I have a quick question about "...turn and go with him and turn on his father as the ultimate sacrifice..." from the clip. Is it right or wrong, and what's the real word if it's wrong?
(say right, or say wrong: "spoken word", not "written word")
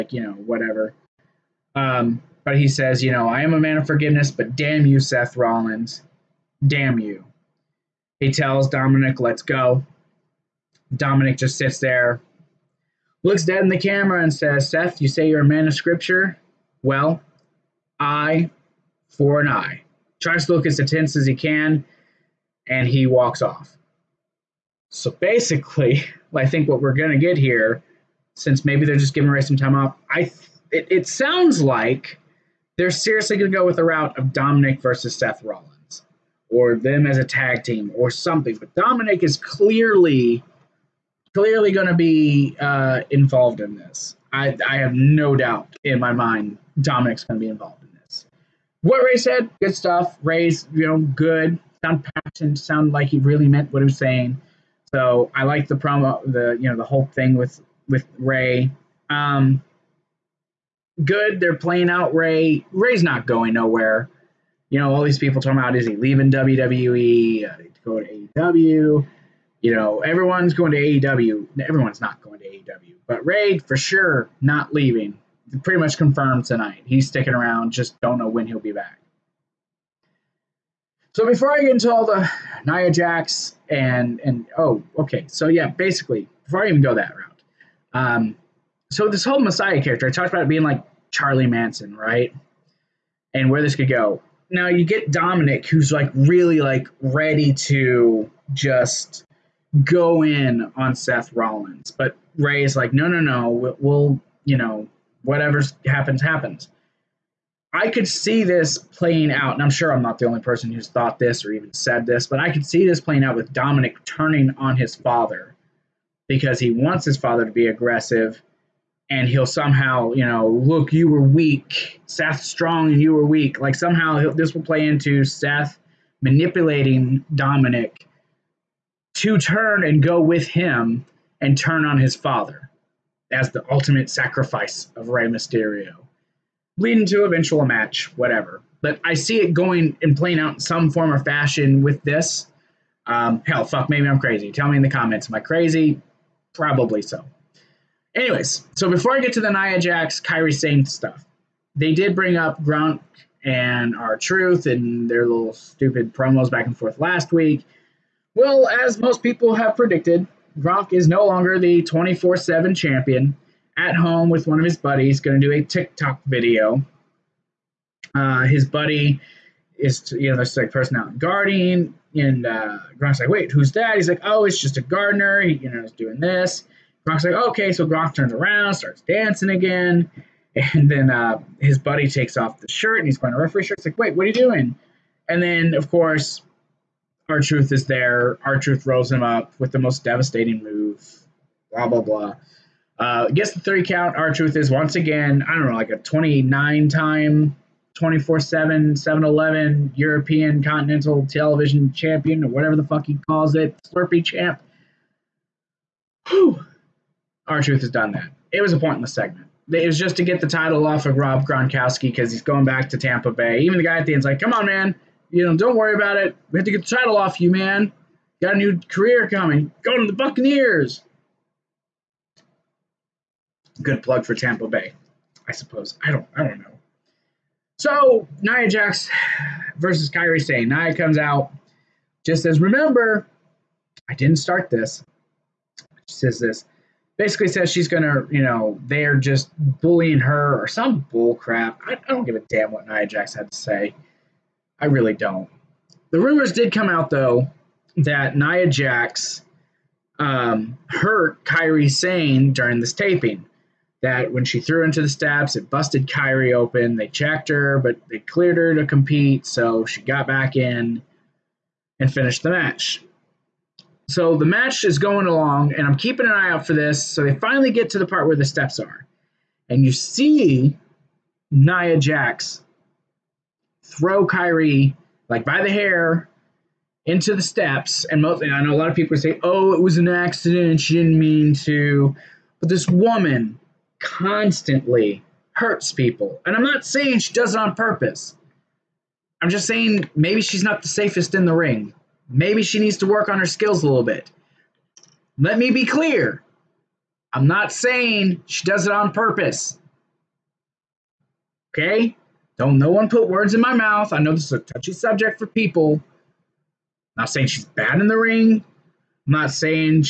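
right.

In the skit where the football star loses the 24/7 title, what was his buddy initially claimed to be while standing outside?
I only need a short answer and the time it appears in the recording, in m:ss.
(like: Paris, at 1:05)
A gardener, at 2:54.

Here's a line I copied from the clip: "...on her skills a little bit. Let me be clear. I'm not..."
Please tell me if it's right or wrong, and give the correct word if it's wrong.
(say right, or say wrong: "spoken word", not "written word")
right.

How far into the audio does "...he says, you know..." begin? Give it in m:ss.
0:02.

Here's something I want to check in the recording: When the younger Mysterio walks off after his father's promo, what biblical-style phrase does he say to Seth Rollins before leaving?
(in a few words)
Eye for an eye.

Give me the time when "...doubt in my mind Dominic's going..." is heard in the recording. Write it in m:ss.
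0:45.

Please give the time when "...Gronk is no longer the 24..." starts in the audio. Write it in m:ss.
2:40.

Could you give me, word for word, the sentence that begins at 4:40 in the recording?
She didn't mean to." But this woman constantly hurts people, and I'm not saying she does it on purpose.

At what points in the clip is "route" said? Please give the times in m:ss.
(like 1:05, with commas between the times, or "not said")
0:33, 1:27.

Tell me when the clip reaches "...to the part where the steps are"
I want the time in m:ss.
4:27.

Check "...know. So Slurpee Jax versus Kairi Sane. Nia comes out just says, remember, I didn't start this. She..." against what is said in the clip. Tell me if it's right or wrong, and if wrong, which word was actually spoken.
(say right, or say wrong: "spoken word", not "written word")
wrong: "Nia", not "Slurpee".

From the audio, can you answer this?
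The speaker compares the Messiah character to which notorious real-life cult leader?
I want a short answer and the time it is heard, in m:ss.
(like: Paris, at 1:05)
Charlie Manson, at 1:31.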